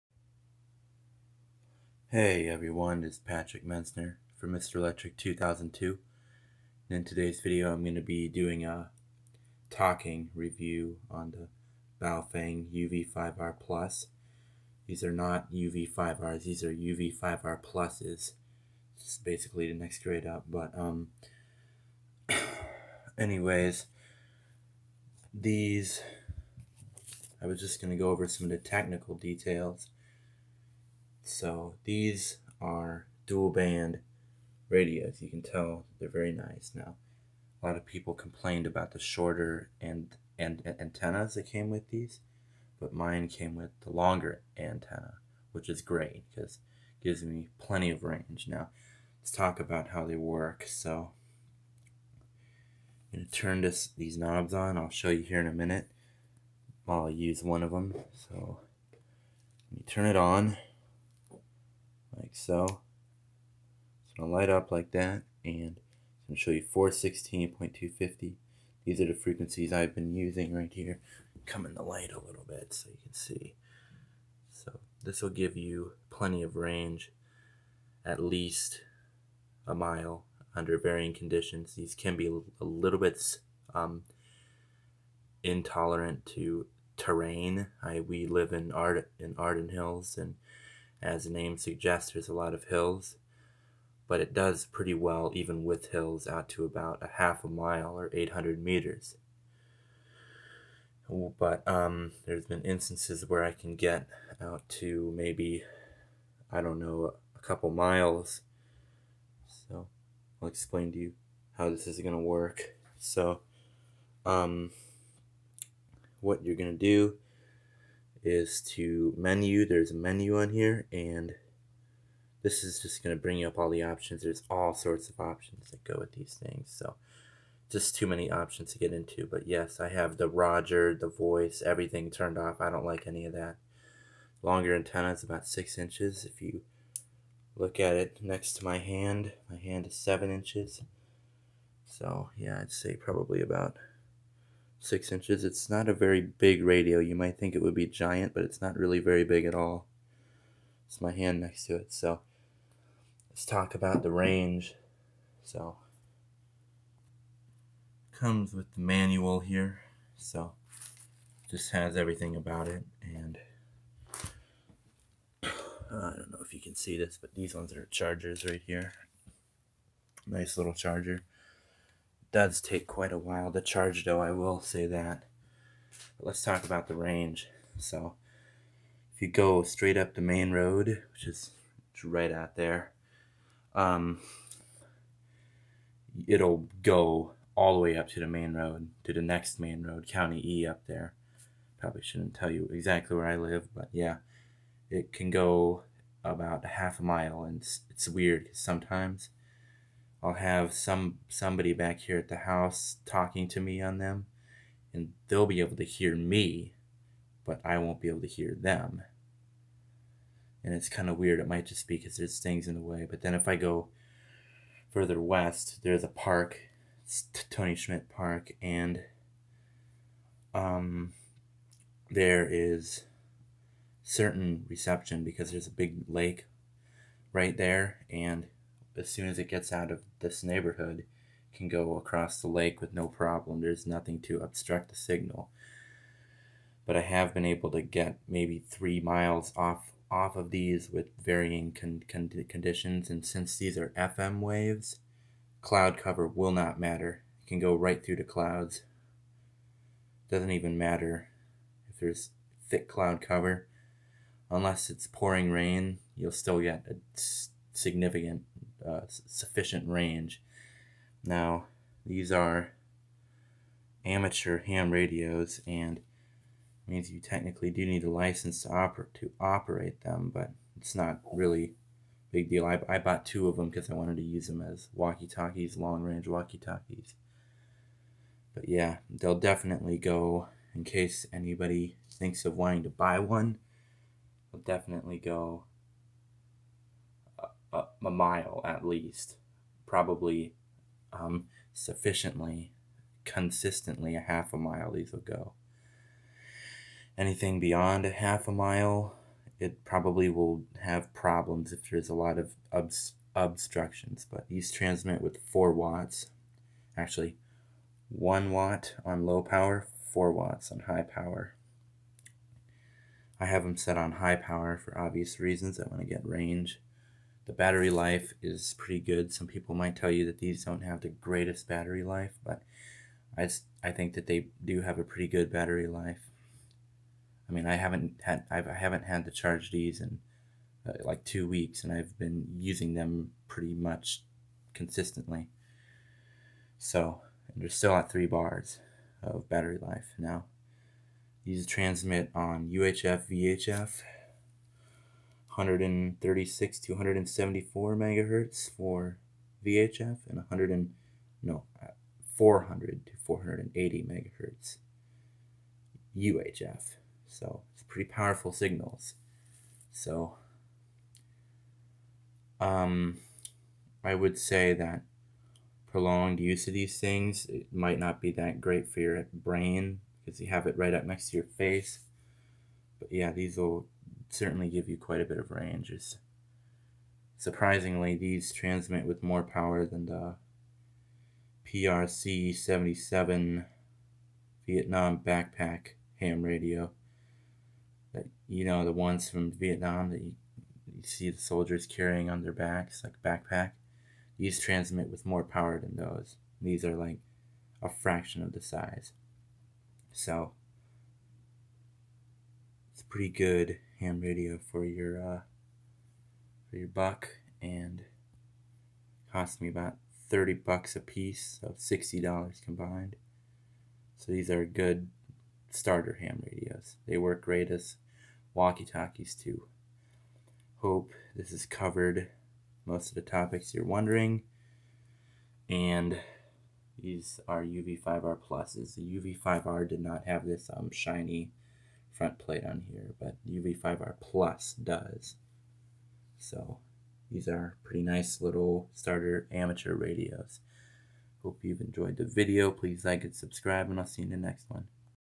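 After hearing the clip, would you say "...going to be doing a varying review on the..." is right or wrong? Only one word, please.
wrong.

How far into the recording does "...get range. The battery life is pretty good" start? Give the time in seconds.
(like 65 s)
316 s.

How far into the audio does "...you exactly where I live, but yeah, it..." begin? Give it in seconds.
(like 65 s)
192 s.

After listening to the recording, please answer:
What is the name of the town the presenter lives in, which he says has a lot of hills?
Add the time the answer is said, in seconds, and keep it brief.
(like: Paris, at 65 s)
Arden Hills, at 89 s.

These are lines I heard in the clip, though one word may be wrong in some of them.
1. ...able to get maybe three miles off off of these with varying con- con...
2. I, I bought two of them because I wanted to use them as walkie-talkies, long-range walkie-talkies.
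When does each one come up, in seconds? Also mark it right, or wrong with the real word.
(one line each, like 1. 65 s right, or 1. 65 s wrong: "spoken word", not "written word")
1. 237 s right
2. 272 s right.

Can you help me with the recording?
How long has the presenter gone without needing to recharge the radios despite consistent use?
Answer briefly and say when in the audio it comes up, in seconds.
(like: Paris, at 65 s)
2 weeks, at 331 s.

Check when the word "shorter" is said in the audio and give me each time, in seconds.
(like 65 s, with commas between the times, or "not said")
38 s.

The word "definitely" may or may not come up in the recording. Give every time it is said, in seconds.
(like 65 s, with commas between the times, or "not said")
279 s, 284 s.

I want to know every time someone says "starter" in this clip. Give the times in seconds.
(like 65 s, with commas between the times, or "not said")
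415 s, 438 s.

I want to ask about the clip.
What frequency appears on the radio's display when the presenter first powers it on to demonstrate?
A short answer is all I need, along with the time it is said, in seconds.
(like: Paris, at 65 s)
416.250, at 66 s.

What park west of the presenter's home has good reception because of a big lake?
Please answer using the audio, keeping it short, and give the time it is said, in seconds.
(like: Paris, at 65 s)
Tony Schmidt Park, at 217 s.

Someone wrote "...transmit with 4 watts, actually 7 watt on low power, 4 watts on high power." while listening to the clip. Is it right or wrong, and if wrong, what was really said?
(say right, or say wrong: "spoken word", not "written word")
wrong: "1", not "7".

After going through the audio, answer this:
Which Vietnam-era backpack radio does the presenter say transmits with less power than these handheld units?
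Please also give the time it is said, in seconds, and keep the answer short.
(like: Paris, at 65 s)
PRC 77, at 381 s.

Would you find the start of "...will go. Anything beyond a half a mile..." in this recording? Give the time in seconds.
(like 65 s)
295 s.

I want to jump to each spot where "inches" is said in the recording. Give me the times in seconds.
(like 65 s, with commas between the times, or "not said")
135 s, 140 s, 145 s.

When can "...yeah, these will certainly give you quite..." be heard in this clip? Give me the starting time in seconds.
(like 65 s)
373 s.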